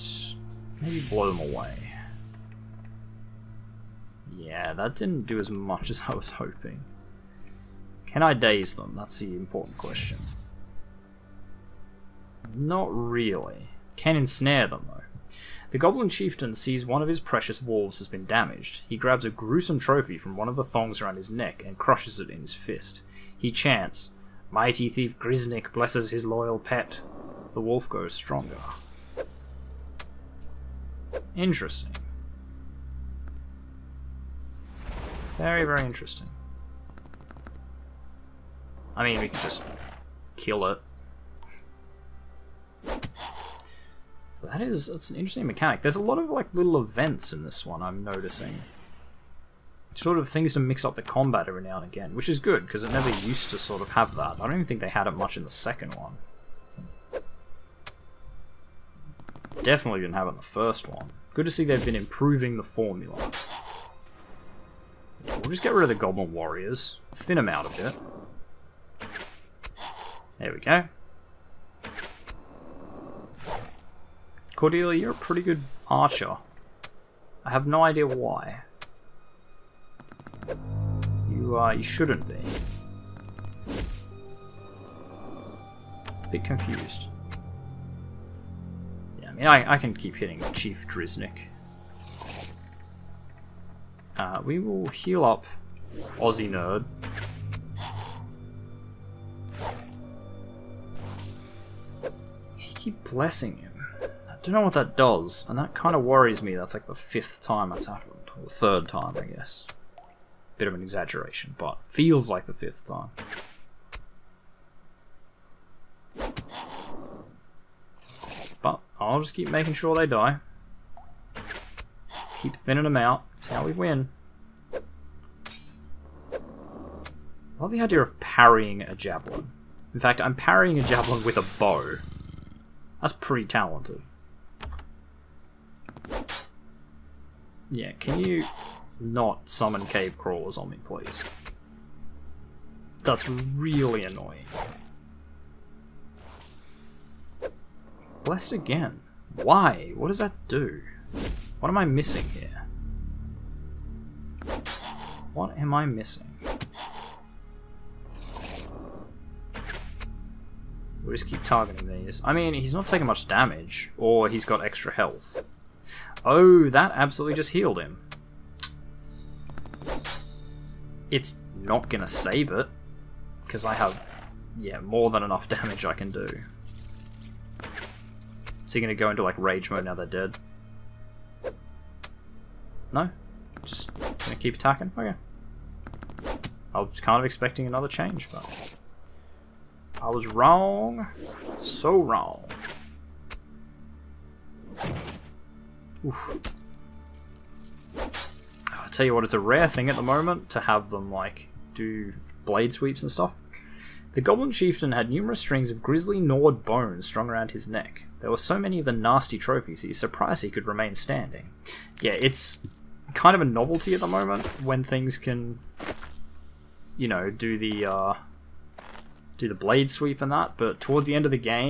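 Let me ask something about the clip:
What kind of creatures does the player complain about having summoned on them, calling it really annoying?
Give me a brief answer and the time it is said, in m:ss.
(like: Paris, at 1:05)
cave crawlers, at 2:19.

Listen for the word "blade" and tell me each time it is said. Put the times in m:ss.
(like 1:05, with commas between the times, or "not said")
3:22, 3:39.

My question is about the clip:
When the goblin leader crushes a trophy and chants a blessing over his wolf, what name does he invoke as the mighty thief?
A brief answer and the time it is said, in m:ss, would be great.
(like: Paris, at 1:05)
Grisnik, at 0:25.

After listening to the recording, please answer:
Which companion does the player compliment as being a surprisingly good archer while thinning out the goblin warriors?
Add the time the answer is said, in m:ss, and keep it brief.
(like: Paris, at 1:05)
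Cordelia, at 1:14.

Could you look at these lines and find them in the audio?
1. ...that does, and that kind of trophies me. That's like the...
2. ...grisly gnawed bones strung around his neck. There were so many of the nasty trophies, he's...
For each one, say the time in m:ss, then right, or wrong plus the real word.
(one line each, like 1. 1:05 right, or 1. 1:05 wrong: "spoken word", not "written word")
1. 1:44 wrong: "worries", not "trophies"
2. 3:25 right.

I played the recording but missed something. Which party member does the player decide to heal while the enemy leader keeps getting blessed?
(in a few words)
Aussie Nerd.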